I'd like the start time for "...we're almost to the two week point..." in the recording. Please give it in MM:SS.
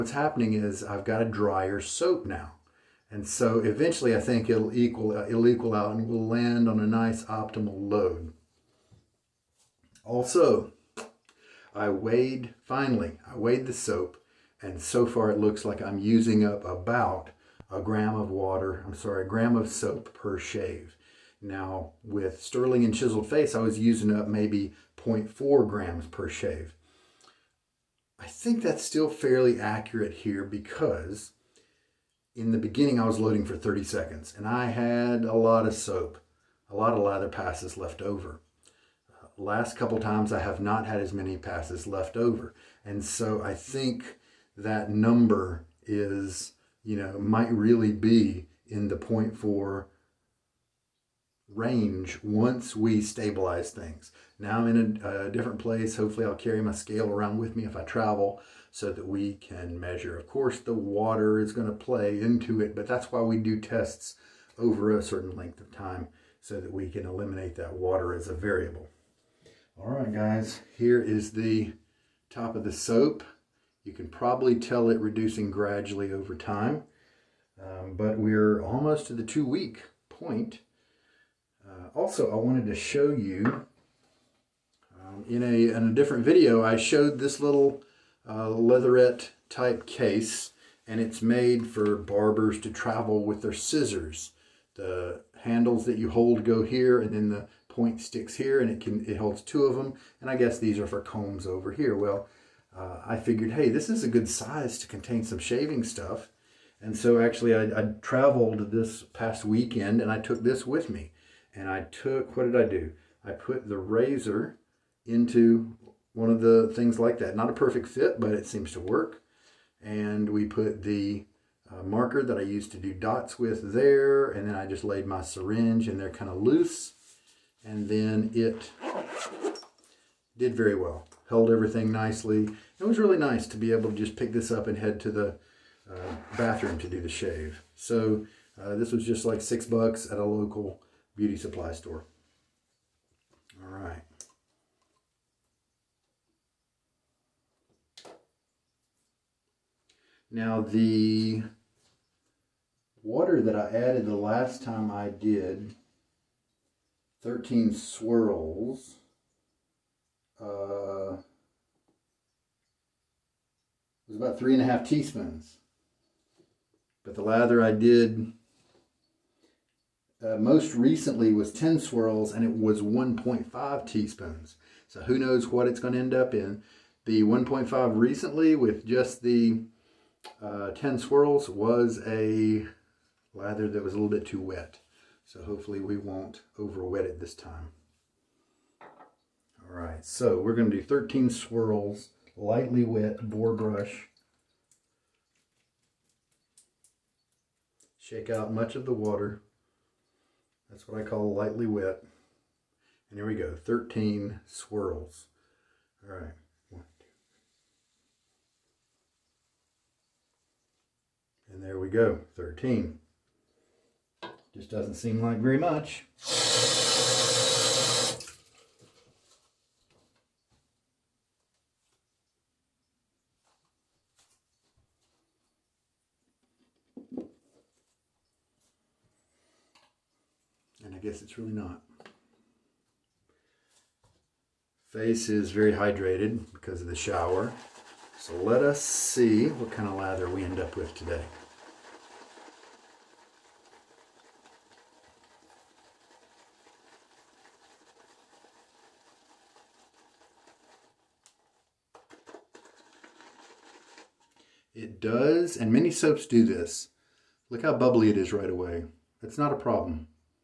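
01:18.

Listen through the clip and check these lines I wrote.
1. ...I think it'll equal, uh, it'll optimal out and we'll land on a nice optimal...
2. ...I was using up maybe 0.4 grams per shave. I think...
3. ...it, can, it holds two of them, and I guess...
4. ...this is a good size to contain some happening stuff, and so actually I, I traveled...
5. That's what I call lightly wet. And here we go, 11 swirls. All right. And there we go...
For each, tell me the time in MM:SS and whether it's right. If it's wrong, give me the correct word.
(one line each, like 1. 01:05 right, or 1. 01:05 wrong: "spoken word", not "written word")
1. 00:04 wrong: "equal", not "optimal"
2. 00:23 right
3. 01:38 right
4. 01:43 wrong: "shaving", not "happening"
5. 03:20 wrong: "13", not "11".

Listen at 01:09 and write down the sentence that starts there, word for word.
All right, guys, here is the top of the soap.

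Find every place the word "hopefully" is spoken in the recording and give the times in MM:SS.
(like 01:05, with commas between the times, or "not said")
00:55, 03:05.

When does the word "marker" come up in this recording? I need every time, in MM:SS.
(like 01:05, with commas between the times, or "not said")
02:01.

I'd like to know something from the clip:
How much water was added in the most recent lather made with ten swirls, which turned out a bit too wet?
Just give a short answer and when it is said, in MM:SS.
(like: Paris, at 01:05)
1.5 teaspoons, at 02:52.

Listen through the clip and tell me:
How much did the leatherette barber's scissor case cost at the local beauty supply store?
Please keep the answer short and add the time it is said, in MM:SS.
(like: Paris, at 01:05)
6 bucks, at 02:19.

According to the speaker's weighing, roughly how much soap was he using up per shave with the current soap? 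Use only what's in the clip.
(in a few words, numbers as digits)
1 gram.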